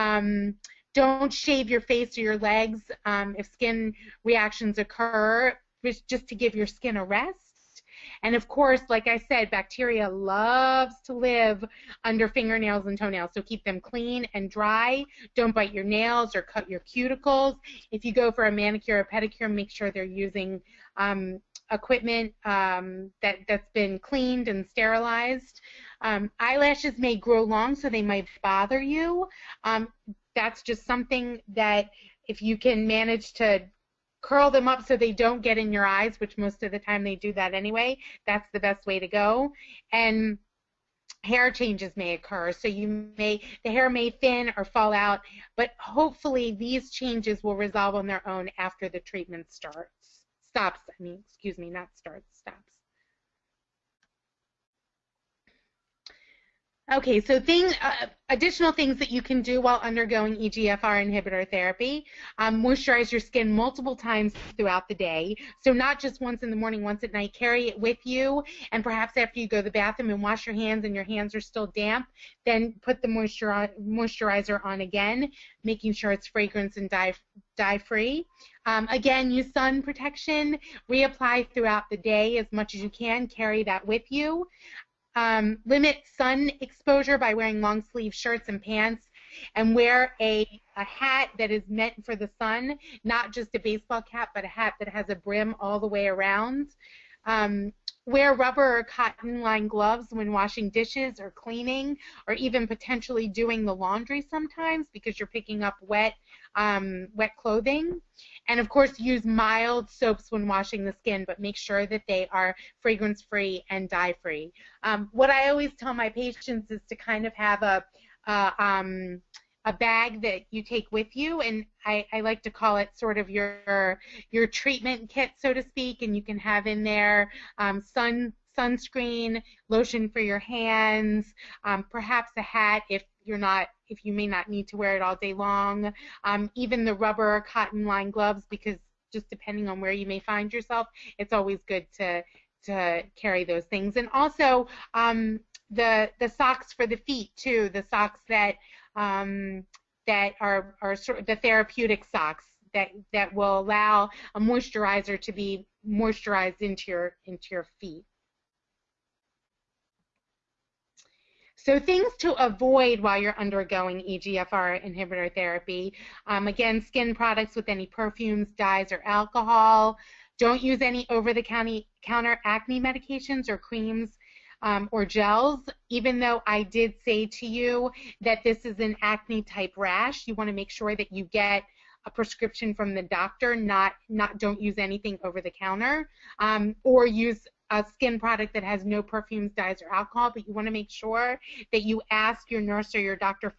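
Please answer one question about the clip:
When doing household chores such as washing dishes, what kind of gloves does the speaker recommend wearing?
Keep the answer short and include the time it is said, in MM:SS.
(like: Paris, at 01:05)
rubber or cotton lined gloves, at 01:38.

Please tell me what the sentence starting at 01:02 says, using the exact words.
Um, moisturize your skin multiple times throughout the day.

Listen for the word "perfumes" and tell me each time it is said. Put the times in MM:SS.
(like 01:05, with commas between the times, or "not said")
02:47, 03:09.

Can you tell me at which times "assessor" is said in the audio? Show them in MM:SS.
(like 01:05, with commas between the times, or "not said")
not said.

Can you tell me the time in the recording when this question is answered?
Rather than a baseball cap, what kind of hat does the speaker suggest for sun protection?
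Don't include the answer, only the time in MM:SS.
01:35.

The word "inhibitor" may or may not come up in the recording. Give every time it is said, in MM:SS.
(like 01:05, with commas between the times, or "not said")
01:01, 02:44.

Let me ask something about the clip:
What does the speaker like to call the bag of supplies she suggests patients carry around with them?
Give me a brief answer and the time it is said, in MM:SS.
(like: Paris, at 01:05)
treatment kit, at 02:04.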